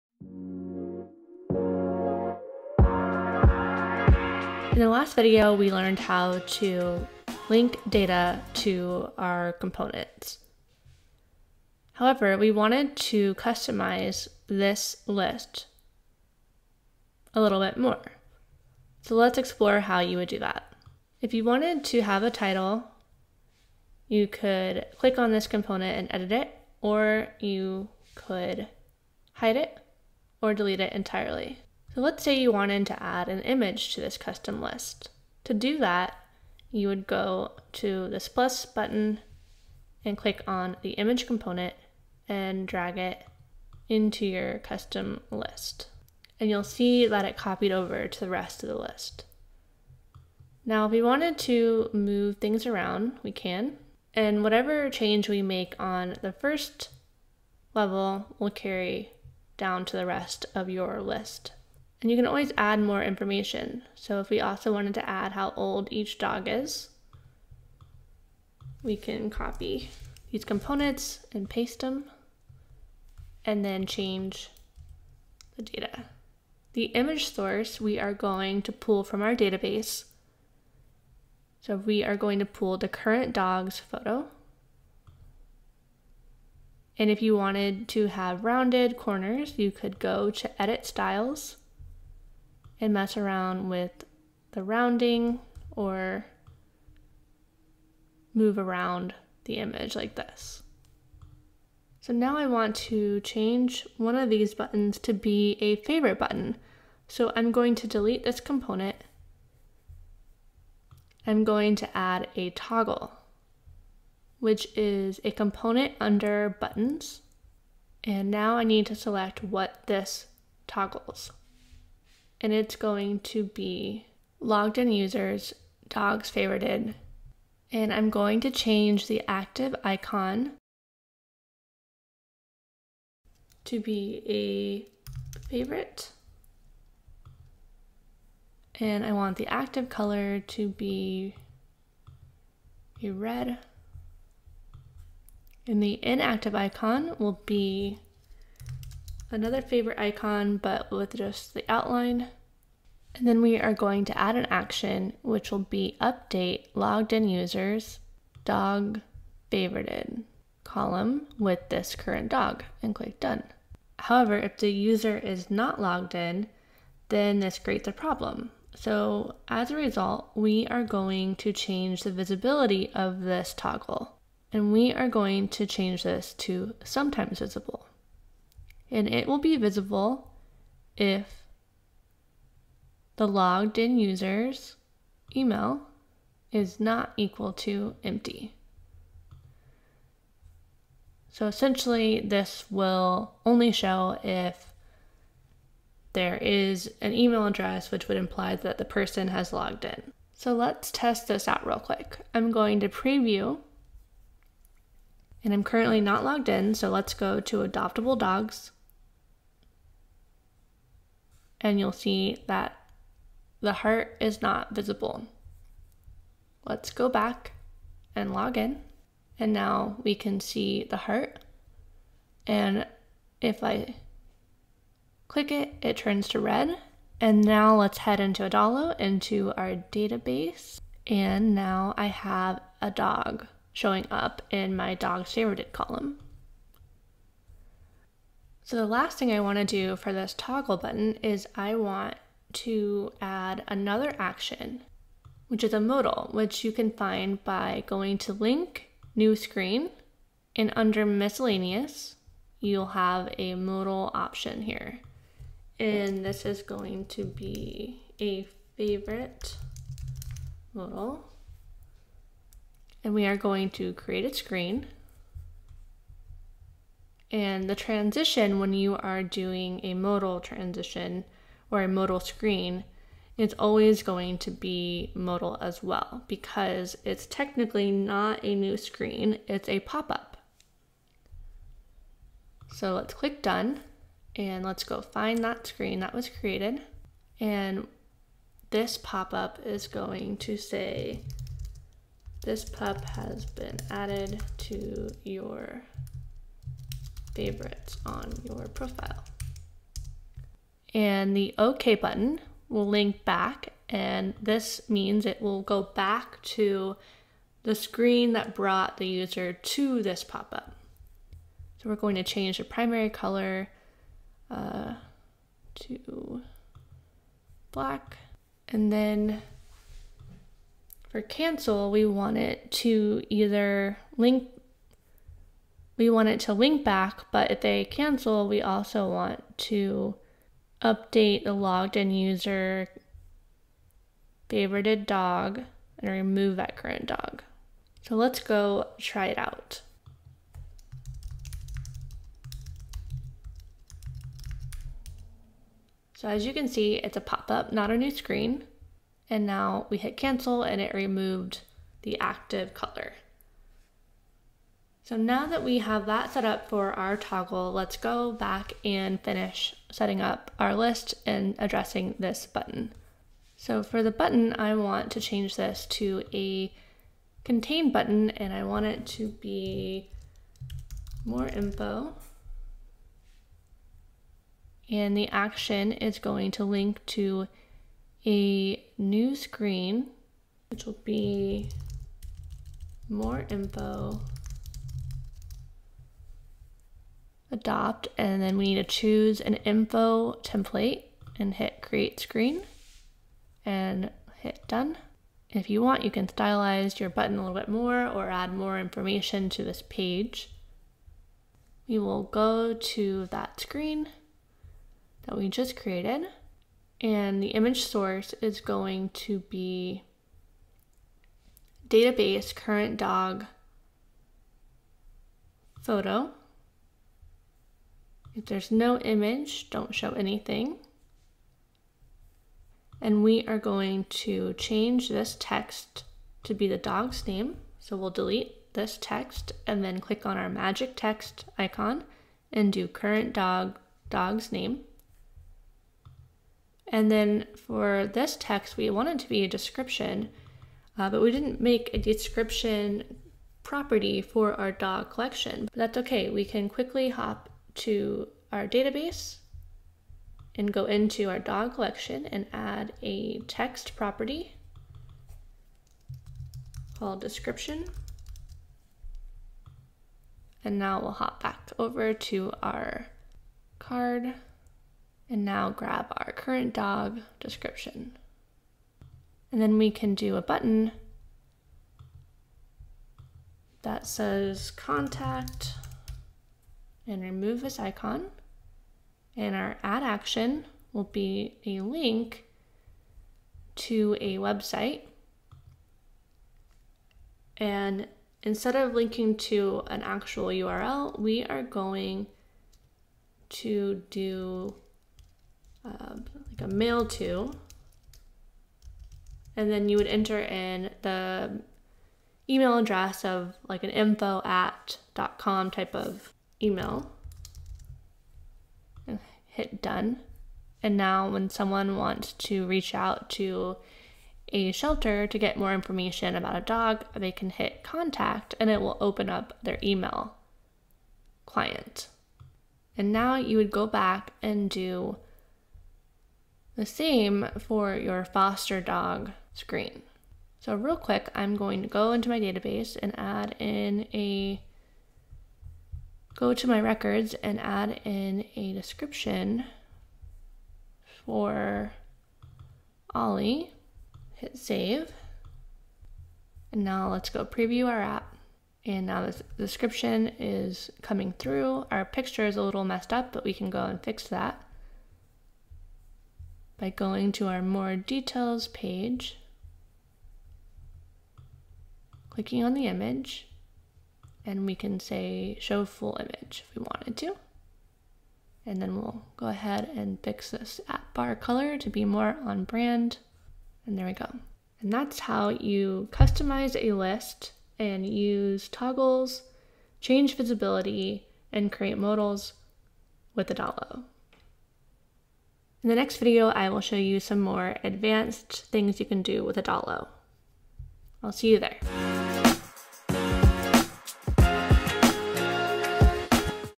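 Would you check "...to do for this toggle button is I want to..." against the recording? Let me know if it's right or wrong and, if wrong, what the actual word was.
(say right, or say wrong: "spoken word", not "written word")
right.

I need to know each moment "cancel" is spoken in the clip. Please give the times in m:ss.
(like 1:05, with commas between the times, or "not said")
5:21, 5:27, 5:50.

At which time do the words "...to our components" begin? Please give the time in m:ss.
0:08.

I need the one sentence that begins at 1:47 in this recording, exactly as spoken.
So I'm going to delete this component.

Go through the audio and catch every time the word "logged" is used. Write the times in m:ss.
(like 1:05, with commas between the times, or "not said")
2:04, 2:36, 2:45, 3:03, 3:19, 3:26, 5:31.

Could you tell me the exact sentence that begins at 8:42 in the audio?
And now you would go back and do the same for your foster dog screen.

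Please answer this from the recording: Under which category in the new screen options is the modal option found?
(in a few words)
Miscellaneous.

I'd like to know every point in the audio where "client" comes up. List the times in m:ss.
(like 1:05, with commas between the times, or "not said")
8:41.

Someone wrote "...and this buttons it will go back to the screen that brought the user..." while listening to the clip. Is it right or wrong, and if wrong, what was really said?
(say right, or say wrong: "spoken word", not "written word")
wrong: "means", not "buttons".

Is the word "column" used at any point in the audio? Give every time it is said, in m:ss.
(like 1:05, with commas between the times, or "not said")
2:40, 3:55.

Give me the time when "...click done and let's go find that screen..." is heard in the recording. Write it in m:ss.
4:43.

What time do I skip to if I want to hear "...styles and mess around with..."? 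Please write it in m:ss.
1:30.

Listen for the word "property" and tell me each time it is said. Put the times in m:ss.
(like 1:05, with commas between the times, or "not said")
7:23, 7:33.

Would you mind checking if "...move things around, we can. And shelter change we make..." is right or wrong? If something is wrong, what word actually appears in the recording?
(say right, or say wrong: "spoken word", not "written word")
wrong: "whatever", not "shelter".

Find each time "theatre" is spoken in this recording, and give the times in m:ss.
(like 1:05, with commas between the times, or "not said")
not said.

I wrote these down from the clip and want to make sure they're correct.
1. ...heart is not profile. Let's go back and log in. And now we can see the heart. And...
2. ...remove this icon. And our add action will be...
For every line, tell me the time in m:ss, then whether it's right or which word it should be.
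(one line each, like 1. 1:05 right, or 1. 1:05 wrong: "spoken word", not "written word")
1. 3:33 wrong: "visible", not "profile"
2. 7:57 right.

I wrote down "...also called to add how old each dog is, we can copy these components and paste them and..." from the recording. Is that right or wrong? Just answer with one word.
wrong.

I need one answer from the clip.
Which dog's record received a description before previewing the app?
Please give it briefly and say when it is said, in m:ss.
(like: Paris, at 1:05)
Ollie, at 9:03.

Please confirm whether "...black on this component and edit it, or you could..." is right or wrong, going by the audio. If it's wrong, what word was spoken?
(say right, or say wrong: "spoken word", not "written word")
wrong: "click", not "black".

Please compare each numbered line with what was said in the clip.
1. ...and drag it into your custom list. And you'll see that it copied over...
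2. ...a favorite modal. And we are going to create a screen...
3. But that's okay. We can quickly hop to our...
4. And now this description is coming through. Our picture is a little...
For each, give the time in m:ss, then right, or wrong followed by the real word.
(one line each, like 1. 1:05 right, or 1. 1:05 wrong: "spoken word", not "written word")
1. 0:42 right
2. 4:18 right
3. 7:25 right
4. 9:08 right.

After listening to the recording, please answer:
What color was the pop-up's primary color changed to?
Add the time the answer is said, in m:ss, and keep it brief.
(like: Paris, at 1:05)
Black, at 5:17.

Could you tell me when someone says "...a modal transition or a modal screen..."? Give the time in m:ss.
4:29.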